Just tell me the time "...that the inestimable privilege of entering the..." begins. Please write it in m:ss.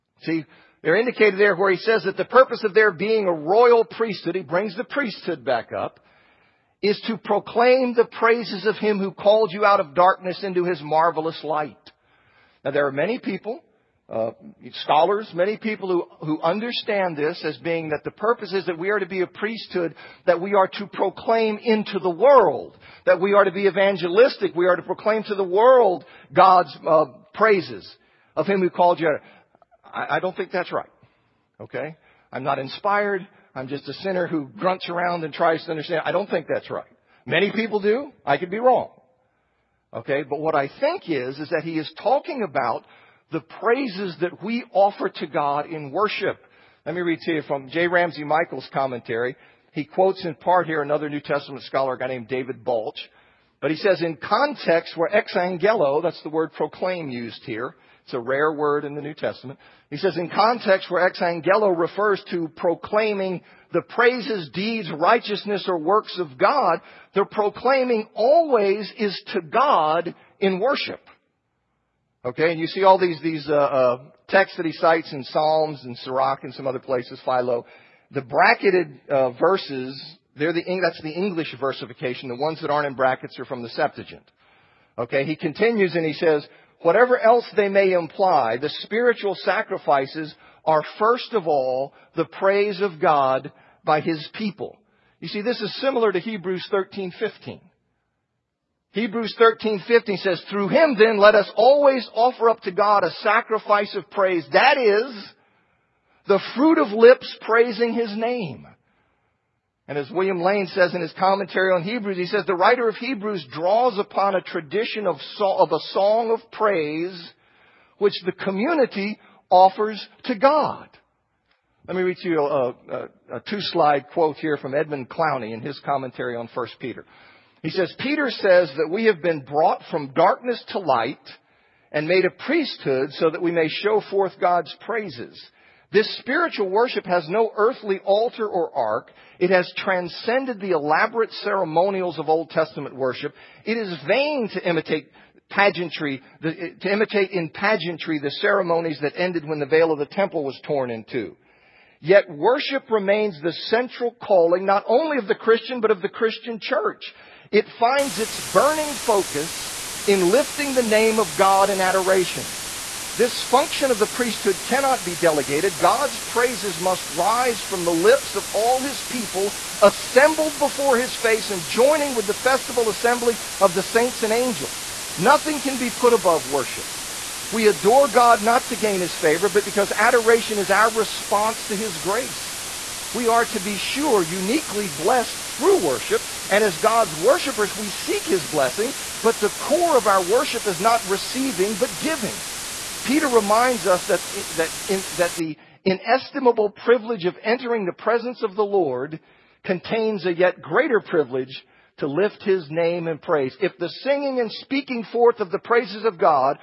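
3:15.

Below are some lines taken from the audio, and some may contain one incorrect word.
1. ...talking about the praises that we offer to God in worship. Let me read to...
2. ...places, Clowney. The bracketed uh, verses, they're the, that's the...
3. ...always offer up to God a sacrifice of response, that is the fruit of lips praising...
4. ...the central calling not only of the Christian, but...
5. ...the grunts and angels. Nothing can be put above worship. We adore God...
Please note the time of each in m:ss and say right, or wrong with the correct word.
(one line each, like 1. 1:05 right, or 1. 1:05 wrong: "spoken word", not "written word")
1. 0:42 right
2. 1:16 wrong: "Philo", not "Clowney"
3. 1:41 wrong: "praise", not "response"
4. 2:33 right
5. 2:53 wrong: "saints", not "grunts".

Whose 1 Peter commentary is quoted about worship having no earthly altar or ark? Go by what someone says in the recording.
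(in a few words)
Edmund Clowney.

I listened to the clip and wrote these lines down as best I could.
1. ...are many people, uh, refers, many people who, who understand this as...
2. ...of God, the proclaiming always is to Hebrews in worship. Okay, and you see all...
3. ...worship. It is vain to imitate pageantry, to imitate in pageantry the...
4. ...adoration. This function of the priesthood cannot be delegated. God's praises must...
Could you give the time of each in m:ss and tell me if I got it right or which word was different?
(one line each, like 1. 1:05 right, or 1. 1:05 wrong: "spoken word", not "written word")
1. 0:12 wrong: "scholars", not "refers"
2. 1:06 wrong: "God", not "Hebrews"
3. 2:22 right
4. 2:41 right.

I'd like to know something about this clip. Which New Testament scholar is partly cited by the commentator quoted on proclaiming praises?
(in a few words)
David Balch.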